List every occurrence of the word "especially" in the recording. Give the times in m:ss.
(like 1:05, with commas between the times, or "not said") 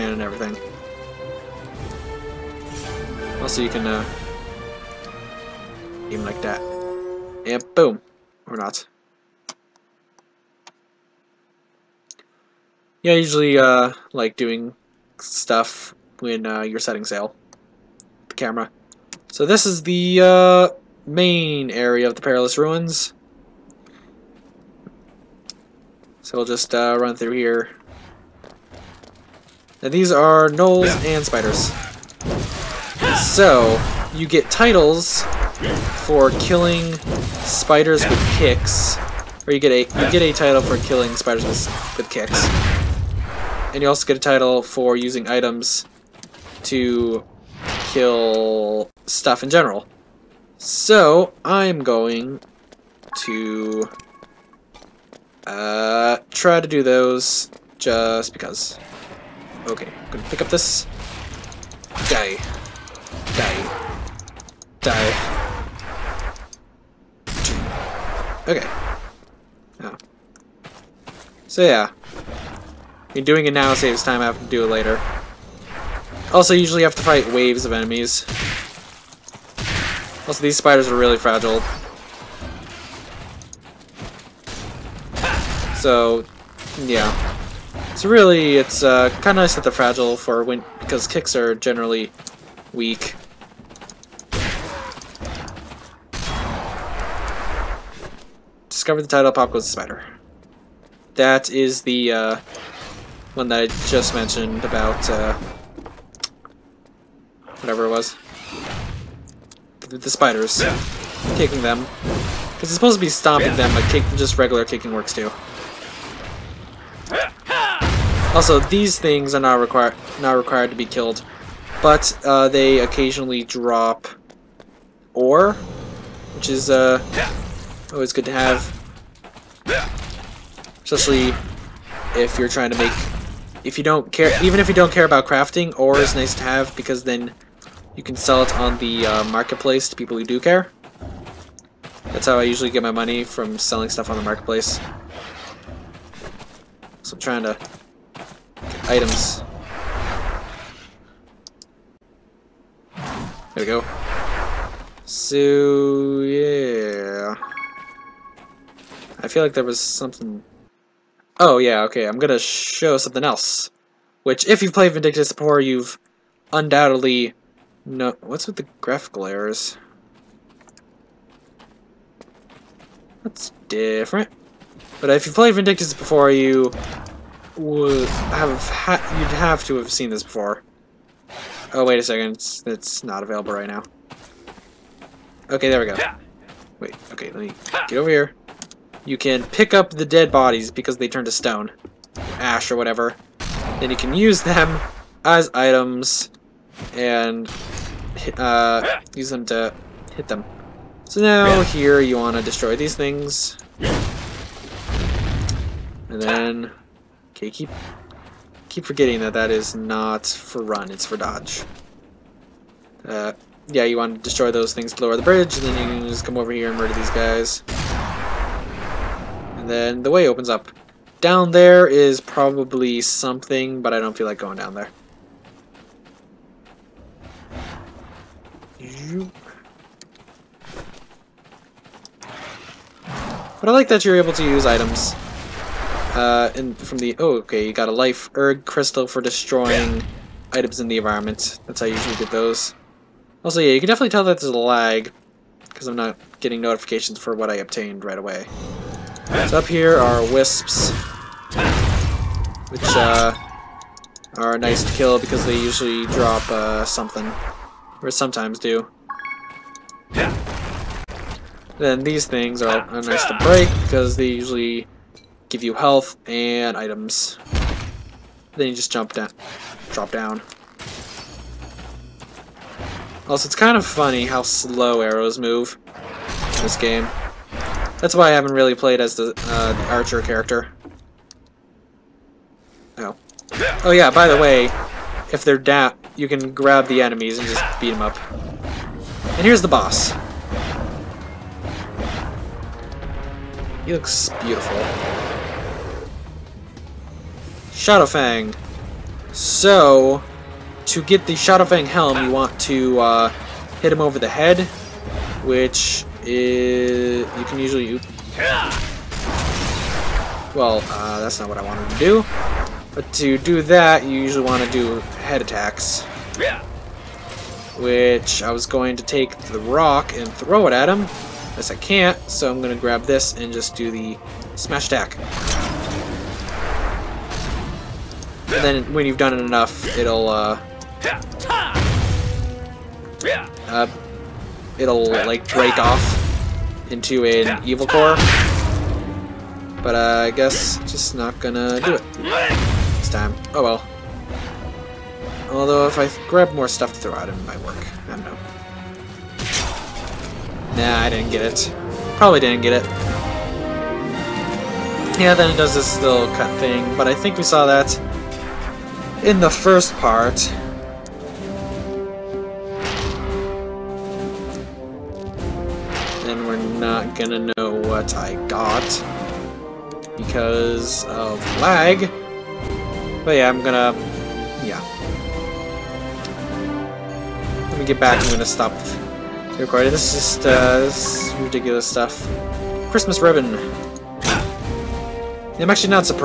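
2:10.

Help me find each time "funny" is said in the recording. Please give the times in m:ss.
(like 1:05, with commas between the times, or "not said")
4:33.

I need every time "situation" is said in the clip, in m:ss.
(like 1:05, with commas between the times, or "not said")
not said.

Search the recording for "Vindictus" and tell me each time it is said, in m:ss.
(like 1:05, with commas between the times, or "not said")
2:44, 2:55.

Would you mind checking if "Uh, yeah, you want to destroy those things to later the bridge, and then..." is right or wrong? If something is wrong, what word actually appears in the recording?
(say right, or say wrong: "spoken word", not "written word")
wrong: "lower", not "later".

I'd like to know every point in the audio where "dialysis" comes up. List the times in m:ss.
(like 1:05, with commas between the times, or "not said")
not said.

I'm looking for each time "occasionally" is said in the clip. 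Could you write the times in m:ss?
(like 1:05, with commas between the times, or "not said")
2:02.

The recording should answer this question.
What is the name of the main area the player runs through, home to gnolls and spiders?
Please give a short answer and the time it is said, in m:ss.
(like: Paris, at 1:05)
Perilous Ruins, at 0:22.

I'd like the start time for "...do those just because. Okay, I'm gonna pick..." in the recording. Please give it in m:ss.
0:56.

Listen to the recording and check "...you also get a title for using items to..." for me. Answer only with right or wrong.
right.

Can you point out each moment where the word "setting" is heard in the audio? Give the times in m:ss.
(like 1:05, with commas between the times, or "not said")
0:16.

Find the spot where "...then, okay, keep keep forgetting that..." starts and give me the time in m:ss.
3:26.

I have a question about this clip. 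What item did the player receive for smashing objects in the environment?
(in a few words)
Life erg crystal.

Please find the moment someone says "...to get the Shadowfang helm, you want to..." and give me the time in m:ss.
5:00.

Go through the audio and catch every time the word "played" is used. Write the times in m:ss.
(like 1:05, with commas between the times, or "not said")
2:44, 2:55, 4:38.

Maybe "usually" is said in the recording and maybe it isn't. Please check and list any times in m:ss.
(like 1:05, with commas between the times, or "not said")
0:13, 1:16, 2:22, 4:01, 4:15, 4:24, 5:07, 5:14.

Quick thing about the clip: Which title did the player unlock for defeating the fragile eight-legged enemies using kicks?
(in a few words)
Pop Goes the Spider.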